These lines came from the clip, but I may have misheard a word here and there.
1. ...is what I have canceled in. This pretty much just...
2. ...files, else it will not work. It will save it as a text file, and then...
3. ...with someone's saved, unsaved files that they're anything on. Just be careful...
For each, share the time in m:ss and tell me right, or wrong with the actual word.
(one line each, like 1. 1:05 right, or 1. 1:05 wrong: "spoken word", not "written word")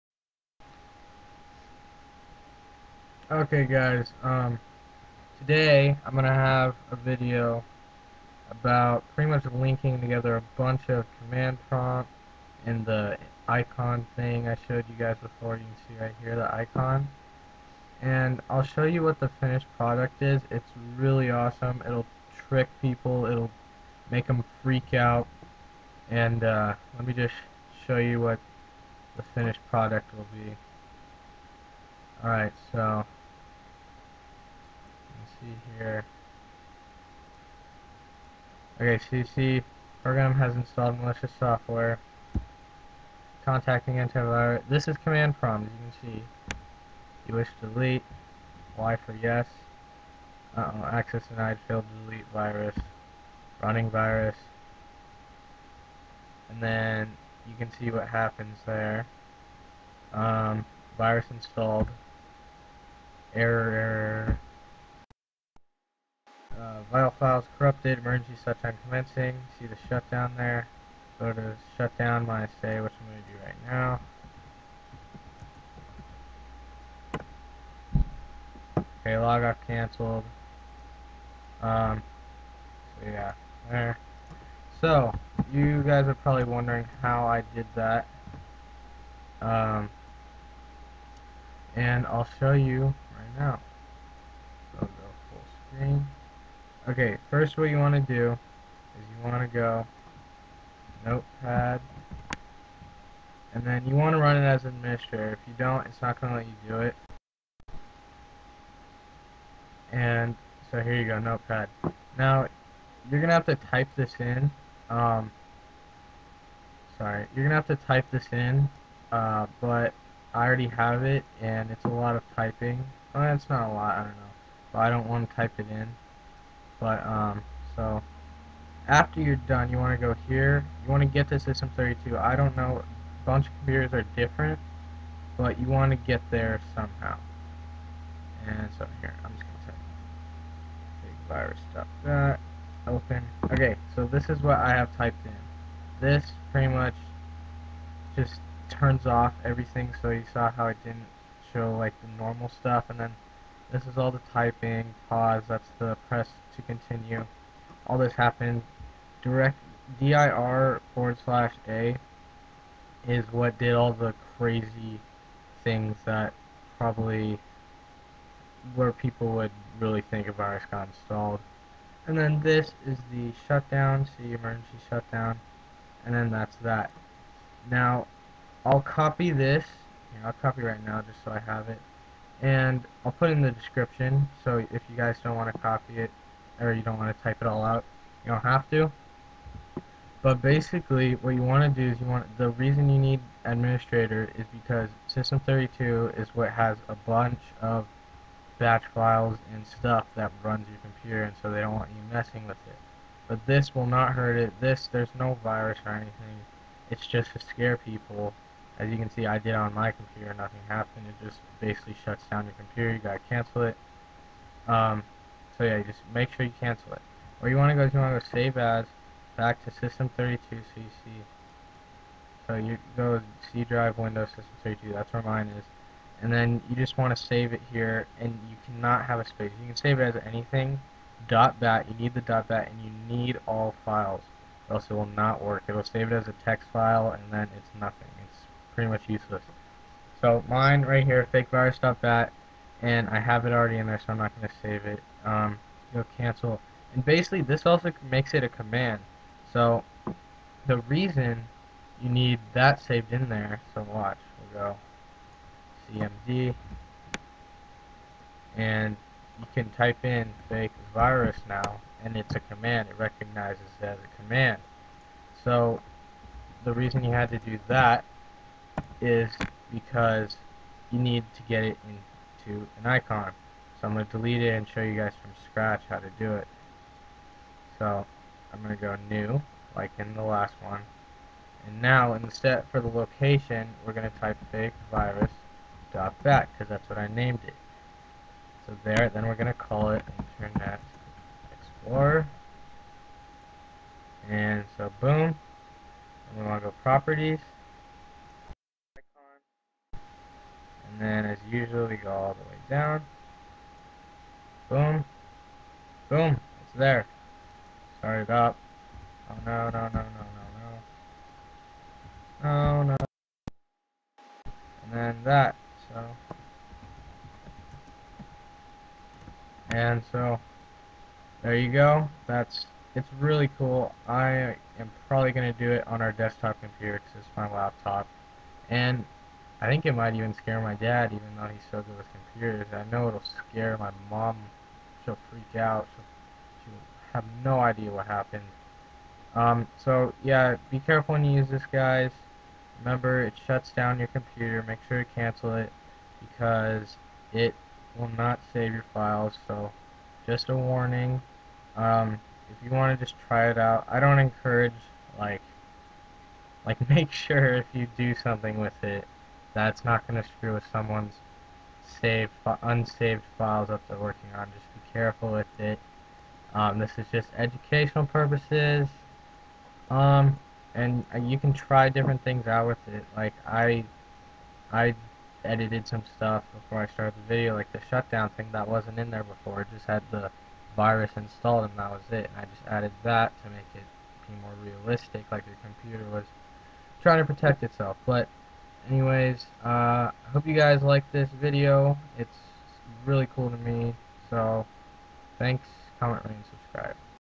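1. 2:24 wrong: "typed", not "canceled"
2. 3:53 right
3. 6:00 wrong: "working", not "anything".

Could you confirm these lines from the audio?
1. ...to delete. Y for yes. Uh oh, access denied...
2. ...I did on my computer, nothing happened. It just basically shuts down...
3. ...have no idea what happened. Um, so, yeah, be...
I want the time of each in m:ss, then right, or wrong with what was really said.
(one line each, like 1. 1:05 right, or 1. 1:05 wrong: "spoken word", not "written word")
1. 0:47 right
2. 3:29 right
3. 5:37 right.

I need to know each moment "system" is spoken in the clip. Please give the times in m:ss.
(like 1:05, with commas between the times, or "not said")
2:11, 3:15, 3:39, 3:44.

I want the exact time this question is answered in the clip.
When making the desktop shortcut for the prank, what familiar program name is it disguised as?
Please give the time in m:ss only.
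4:50.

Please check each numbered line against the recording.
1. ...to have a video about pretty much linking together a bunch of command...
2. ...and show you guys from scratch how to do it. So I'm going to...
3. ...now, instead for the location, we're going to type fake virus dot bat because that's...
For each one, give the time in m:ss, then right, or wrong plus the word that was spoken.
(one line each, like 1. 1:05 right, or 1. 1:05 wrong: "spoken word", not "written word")
1. 0:06 right
2. 4:34 right
3. 4:41 right.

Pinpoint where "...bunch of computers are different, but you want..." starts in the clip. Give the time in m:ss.
2:13.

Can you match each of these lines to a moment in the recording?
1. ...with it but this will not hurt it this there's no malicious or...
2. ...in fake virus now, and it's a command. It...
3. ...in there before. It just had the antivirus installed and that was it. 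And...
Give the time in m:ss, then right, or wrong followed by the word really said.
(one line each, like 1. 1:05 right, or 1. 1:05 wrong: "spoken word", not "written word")
1. 3:22 wrong: "virus", not "malicious"
2. 4:20 right
3. 6:18 wrong: "virus", not "antivirus".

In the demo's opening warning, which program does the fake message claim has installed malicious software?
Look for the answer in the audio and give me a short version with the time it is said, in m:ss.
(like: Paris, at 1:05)
CC, at 0:39.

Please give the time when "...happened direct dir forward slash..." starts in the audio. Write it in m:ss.
2:38.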